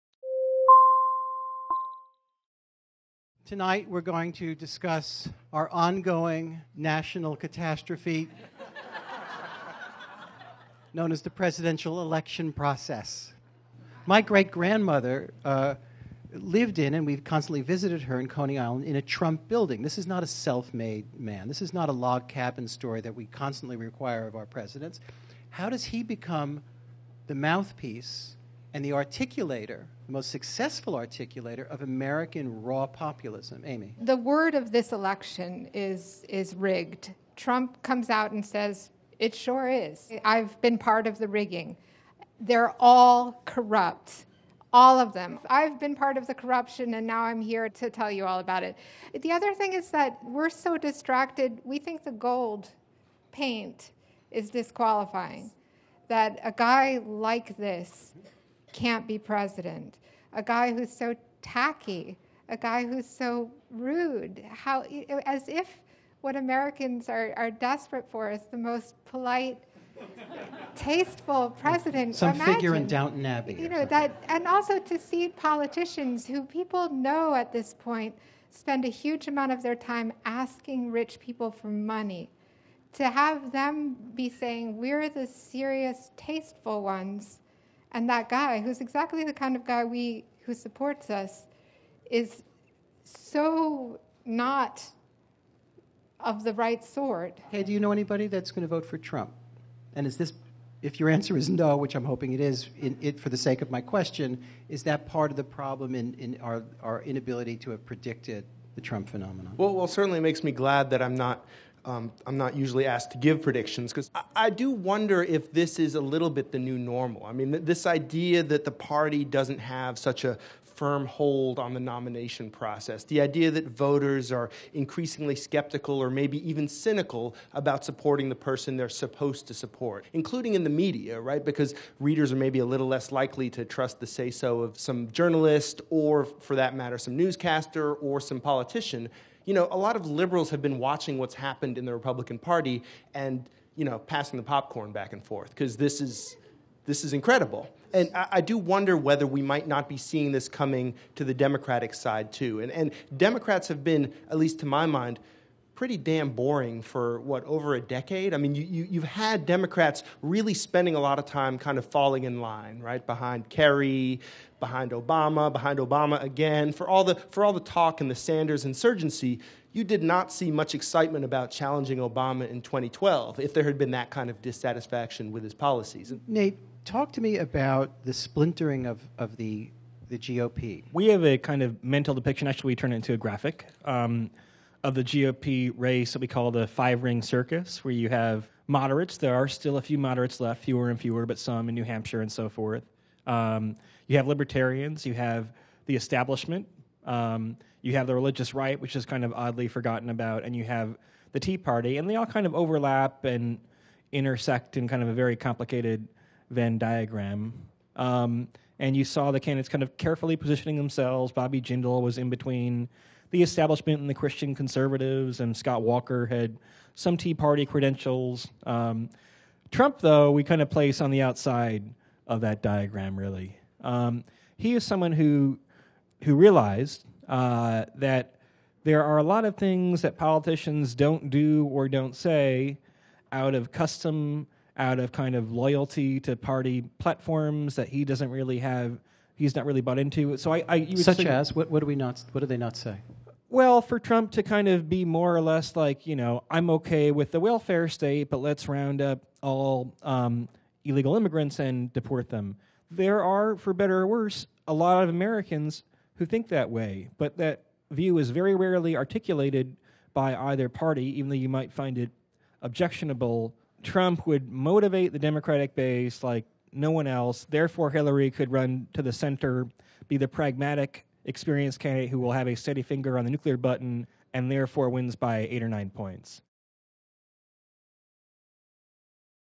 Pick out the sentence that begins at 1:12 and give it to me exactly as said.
Some Imagine, figure in Downton Abbey.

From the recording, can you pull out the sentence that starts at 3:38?
Um, Trump, though, we kind of place on the outside of that diagram, really.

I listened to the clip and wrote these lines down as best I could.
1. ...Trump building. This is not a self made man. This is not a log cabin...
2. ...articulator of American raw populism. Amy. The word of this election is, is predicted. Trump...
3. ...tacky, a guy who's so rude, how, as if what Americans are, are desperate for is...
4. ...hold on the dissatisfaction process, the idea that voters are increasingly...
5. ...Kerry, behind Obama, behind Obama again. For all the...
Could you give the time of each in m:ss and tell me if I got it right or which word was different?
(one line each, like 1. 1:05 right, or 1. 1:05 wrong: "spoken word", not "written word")
1. 0:19 right
2. 0:30 wrong: "rigged", not "predicted"
3. 1:01 right
4. 2:01 wrong: "nomination", not "dissatisfaction"
5. 2:43 right.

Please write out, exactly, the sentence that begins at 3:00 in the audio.
We have a kind of mental depiction.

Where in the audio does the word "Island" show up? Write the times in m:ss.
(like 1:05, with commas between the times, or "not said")
0:18.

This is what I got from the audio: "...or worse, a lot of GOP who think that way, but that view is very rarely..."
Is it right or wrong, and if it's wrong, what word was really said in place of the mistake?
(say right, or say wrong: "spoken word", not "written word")
wrong: "Americans", not "GOP".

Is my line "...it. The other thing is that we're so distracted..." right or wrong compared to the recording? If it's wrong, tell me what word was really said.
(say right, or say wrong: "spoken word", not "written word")
right.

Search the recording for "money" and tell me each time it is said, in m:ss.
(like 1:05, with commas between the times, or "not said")
1:21.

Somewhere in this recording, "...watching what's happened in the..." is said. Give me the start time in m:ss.
2:20.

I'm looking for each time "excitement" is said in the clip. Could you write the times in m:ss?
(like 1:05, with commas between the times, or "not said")
2:50.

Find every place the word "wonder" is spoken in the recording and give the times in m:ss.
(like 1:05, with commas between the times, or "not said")
1:54, 2:28.